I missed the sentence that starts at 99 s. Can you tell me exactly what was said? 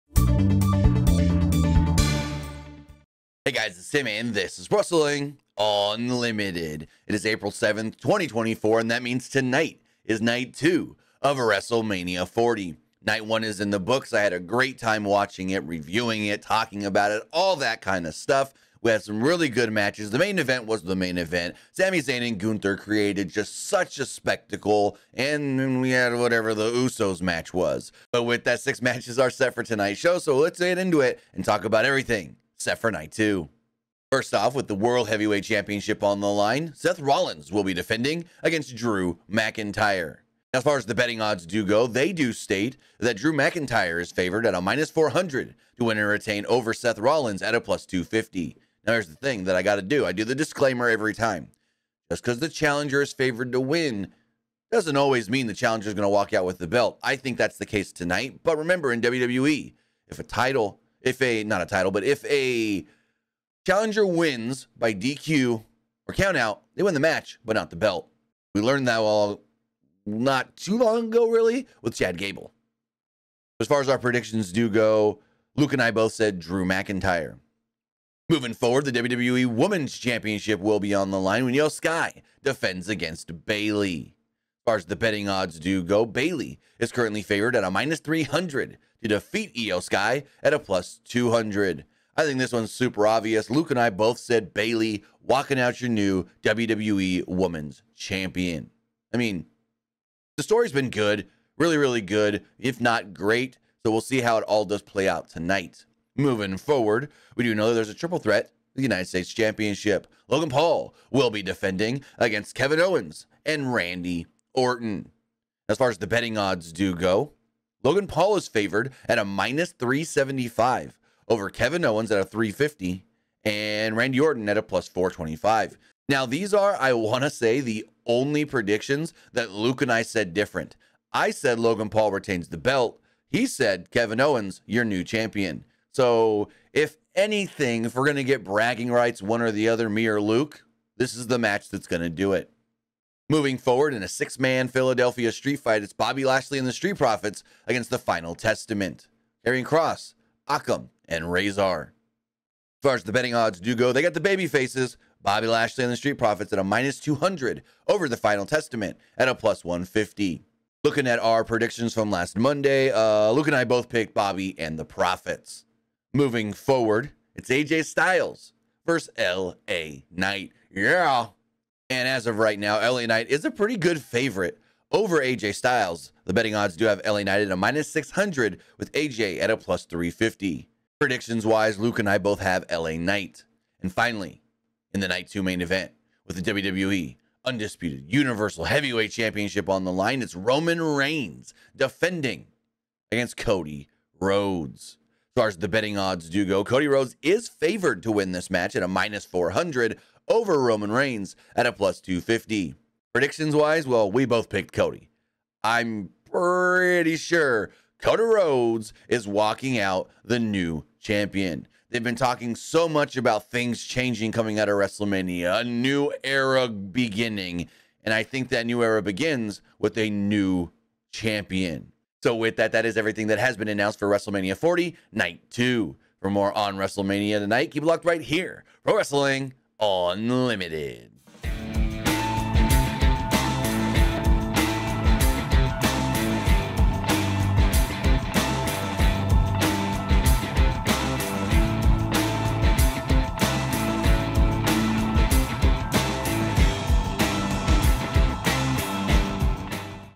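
I mean, the story's been good, really, really good, if not great.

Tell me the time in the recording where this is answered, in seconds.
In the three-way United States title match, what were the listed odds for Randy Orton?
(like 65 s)
124 s.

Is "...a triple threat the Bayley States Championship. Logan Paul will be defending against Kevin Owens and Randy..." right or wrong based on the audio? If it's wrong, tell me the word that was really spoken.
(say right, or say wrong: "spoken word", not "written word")
wrong: "United", not "Bayley".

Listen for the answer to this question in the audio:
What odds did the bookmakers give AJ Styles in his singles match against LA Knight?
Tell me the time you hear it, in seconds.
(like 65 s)
179 s.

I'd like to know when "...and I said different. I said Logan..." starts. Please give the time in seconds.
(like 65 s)
129 s.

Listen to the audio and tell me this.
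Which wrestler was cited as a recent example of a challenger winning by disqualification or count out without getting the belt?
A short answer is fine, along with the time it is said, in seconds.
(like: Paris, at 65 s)
Chad Gable, at 71 s.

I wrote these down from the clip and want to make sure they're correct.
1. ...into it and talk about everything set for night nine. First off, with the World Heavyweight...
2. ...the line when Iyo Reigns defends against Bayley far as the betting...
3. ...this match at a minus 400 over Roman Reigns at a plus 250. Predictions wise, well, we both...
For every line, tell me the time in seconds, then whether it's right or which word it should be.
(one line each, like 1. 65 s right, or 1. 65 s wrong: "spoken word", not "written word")
1. 30 s wrong: "two", not "nine"
2. 81 s wrong: "Sky", not "Reigns"
3. 198 s right.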